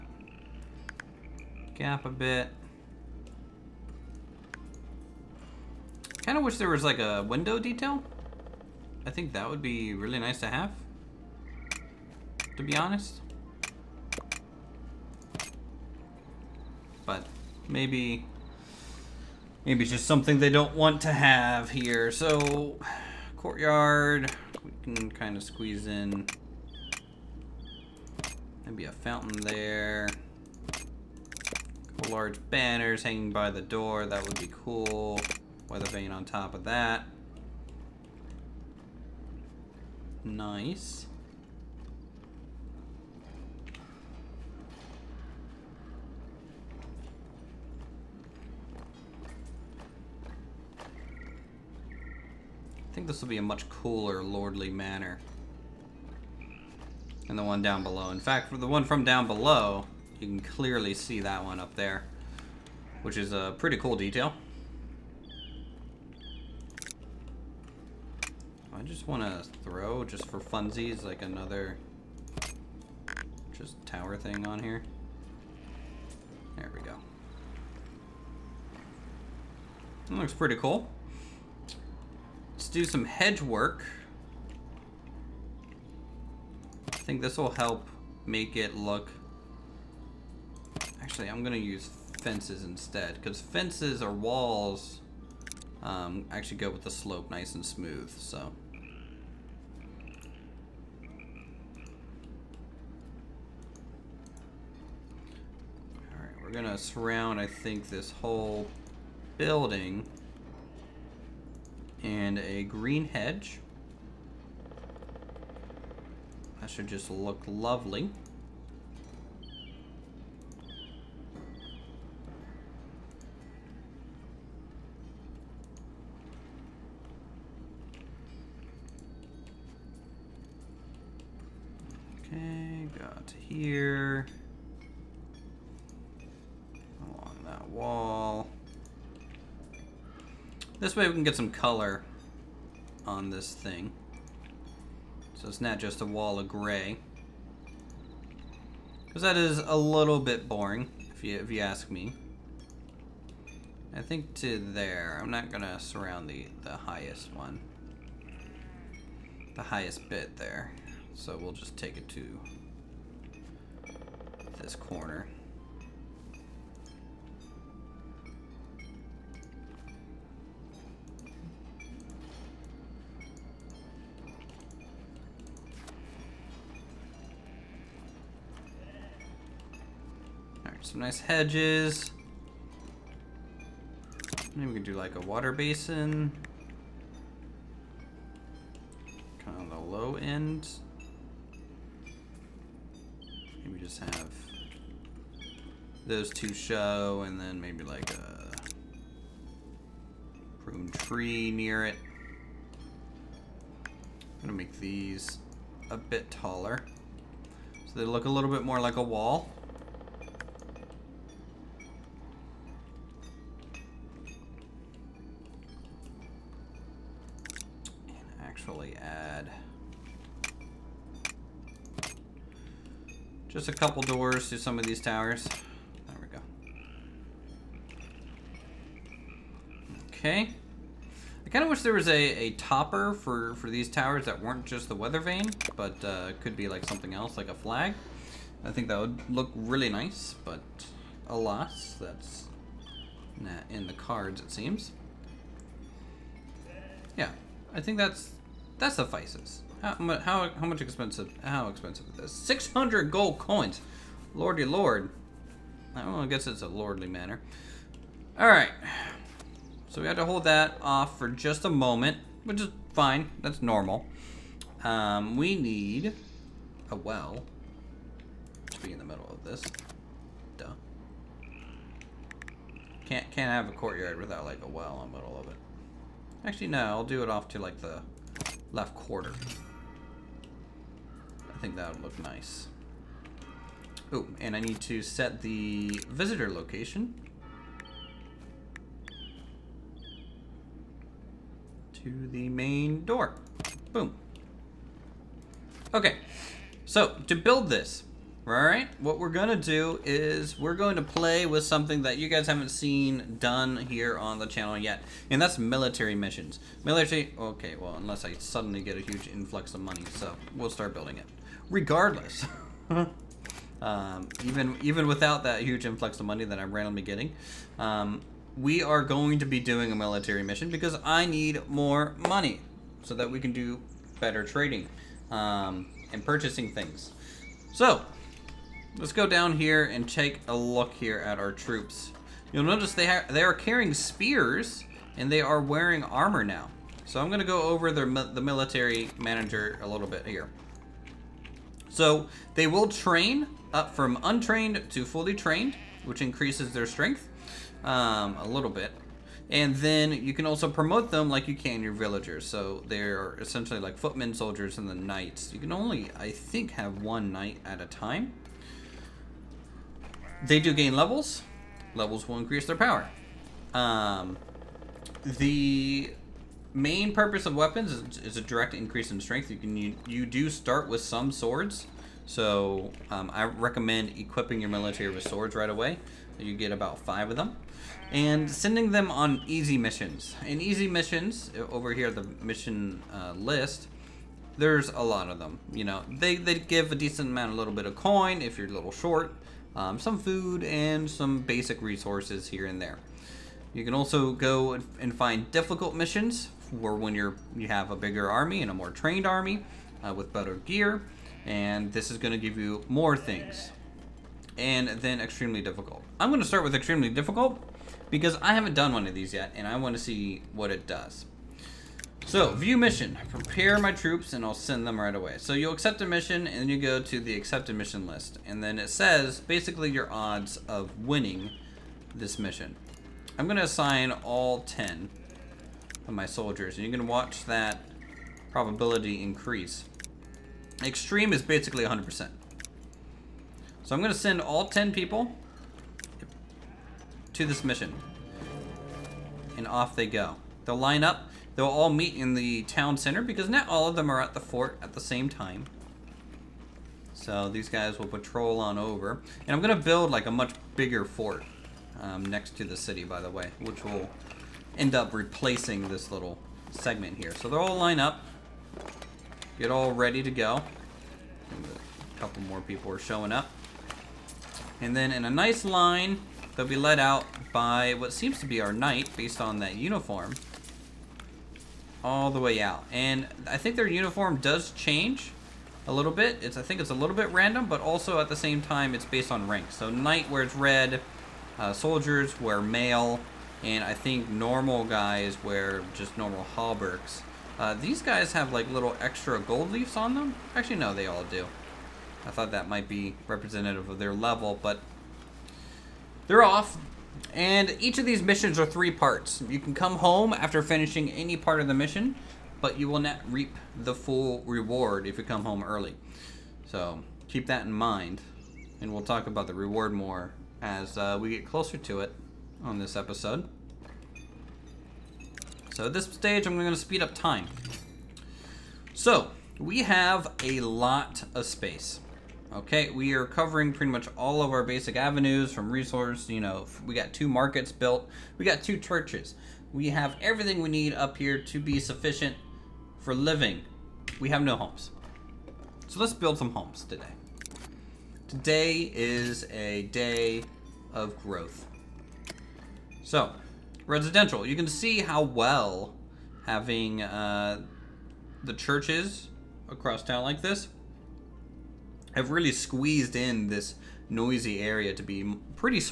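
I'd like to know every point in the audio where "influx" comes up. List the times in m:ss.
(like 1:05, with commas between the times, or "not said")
5:09, 5:15.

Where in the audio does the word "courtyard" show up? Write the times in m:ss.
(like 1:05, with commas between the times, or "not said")
0:23, 4:33.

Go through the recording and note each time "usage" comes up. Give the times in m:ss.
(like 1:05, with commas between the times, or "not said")
not said.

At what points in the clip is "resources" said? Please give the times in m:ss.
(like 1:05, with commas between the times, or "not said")
6:31, 8:45.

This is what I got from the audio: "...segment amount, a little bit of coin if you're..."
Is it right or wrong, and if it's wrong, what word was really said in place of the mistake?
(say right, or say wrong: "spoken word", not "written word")
wrong: "decent", not "segment".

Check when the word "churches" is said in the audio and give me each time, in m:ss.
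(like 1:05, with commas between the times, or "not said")
8:48, 9:08.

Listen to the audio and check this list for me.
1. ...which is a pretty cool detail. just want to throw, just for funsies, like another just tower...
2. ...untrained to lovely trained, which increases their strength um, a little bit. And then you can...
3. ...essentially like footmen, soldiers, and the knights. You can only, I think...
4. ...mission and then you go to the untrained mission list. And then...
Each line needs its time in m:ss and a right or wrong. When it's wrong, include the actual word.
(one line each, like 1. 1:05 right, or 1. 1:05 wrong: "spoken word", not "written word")
1. 1:03 right
2. 5:44 wrong: "fully", not "lovely"
3. 5:53 right
4. 6:56 wrong: "accepted", not "untrained".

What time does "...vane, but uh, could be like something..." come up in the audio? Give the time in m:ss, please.
3:55.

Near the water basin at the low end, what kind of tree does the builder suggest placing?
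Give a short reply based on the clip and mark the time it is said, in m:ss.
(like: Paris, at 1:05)
Prune tree, at 3:20.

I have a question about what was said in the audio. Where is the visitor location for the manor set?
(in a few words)
The main door.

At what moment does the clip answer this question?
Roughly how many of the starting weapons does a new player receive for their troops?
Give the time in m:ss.
6:16.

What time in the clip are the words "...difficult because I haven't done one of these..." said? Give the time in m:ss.
6:47.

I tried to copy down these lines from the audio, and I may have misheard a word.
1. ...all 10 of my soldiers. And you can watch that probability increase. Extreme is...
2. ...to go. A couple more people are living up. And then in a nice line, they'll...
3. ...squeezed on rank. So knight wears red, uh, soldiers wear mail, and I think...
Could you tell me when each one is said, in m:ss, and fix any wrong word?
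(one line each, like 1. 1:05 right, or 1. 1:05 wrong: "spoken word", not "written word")
1. 7:04 right
2. 7:40 wrong: "showing", not "living"
3. 7:59 wrong: "based", not "squeezed".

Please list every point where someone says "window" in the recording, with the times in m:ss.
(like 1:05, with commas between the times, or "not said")
0:07.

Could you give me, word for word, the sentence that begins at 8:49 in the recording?
We have everything we need up here to be sufficient for living.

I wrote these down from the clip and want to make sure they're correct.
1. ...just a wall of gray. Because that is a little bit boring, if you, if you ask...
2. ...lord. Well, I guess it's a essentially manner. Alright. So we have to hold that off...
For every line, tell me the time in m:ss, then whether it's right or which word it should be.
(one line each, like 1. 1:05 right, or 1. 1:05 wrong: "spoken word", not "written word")
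1. 2:25 right
2. 4:14 wrong: "lordly", not "essentially".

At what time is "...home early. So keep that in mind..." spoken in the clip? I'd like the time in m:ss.
8:25.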